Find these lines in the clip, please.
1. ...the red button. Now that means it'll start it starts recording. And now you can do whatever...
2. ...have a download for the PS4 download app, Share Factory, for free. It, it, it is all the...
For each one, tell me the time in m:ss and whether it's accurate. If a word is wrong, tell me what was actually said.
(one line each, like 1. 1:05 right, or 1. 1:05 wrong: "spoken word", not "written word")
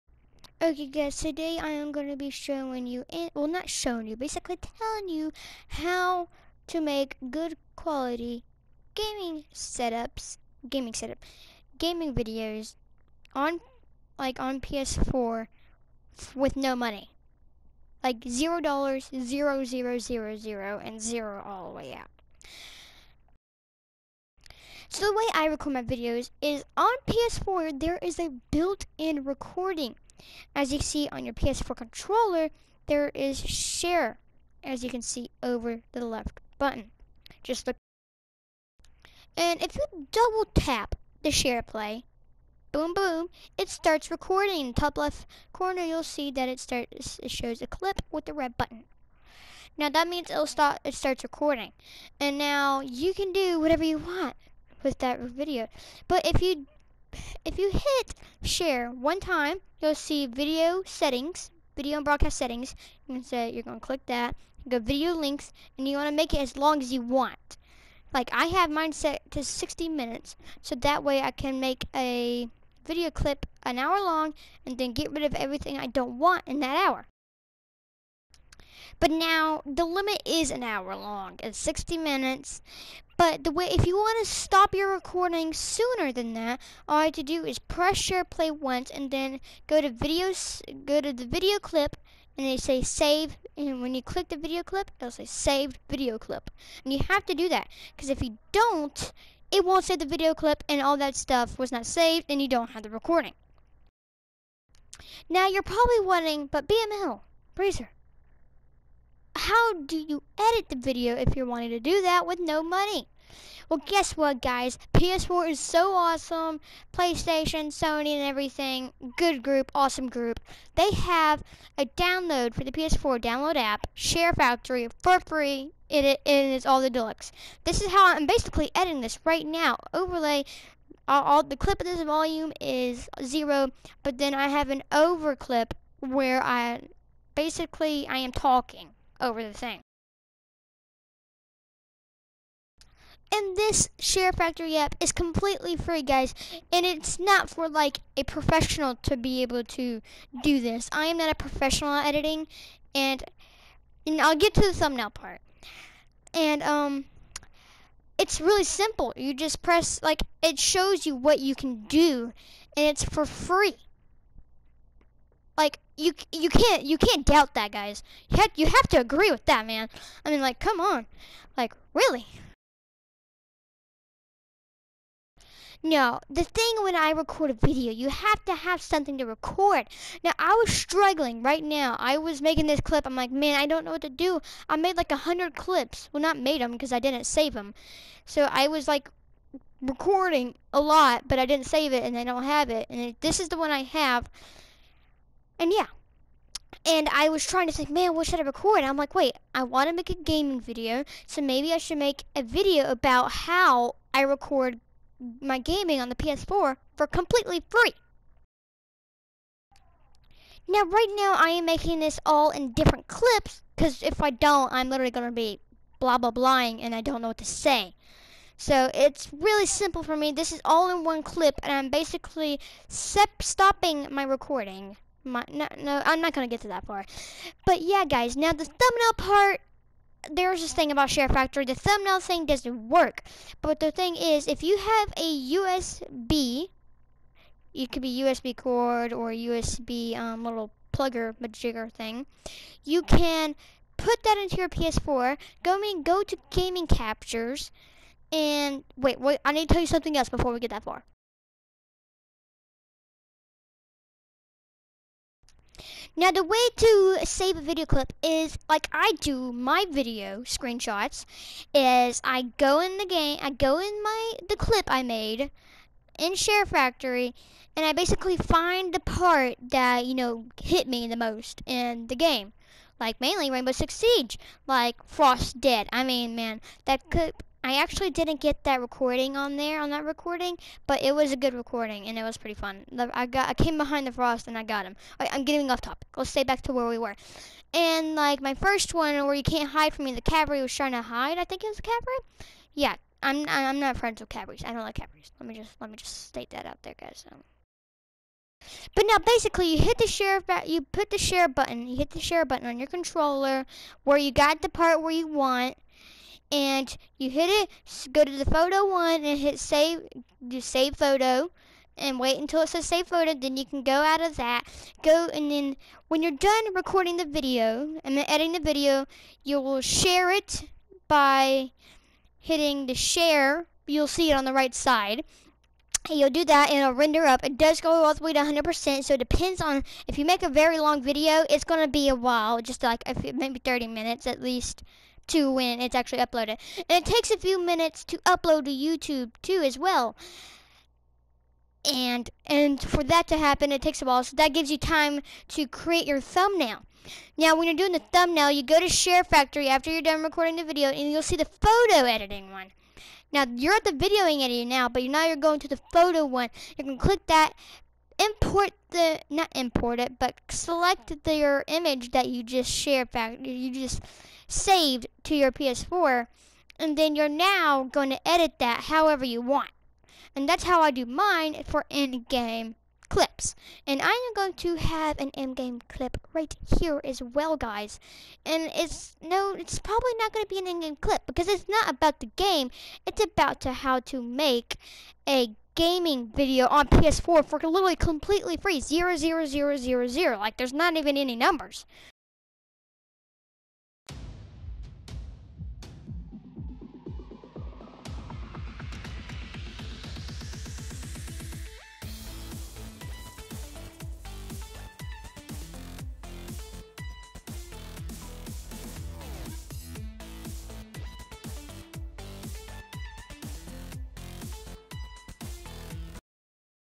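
1. 0:48 right
2. 2:00 right.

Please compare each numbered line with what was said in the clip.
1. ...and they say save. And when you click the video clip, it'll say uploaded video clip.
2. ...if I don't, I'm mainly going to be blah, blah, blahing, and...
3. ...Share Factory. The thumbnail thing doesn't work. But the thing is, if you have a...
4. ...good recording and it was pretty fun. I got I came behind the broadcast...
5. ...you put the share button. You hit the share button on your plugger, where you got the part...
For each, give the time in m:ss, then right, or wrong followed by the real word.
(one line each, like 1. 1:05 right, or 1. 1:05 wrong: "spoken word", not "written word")
1. 1:32 wrong: "saved", not "uploaded"
2. 3:34 wrong: "literally", not "mainly"
3. 3:51 right
4. 4:41 wrong: "frost", not "broadcast"
5. 5:00 wrong: "controller", not "plugger".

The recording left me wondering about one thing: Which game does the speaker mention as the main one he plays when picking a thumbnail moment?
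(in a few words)
Rainbow Six Siege.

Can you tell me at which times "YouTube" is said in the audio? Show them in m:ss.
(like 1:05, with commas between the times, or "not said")
5:38.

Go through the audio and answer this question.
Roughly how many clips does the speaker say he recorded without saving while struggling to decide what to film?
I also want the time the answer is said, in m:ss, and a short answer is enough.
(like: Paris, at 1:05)
100, at 3:05.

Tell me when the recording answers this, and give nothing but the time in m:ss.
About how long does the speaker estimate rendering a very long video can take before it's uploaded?
5:33.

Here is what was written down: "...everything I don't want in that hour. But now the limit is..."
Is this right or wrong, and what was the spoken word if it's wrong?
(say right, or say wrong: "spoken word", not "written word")
right.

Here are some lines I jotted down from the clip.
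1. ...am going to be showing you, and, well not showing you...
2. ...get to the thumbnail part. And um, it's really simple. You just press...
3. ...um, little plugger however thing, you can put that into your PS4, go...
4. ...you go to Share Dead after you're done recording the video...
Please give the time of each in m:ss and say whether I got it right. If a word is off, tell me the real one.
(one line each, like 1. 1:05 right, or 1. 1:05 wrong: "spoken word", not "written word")
1. 0:01 right
2. 2:34 right
3. 4:00 wrong: "majigger", not "however"
4. 5:48 wrong: "Factory", not "Dead".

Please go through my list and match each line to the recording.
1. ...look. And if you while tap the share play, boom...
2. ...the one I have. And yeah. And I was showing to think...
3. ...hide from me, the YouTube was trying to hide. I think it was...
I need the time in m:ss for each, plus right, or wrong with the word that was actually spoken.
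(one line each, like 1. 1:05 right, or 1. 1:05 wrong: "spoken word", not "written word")
1. 0:37 wrong: "double", not "while"
2. 3:13 wrong: "trying", not "showing"
3. 4:49 wrong: "Cadbury", not "YouTube".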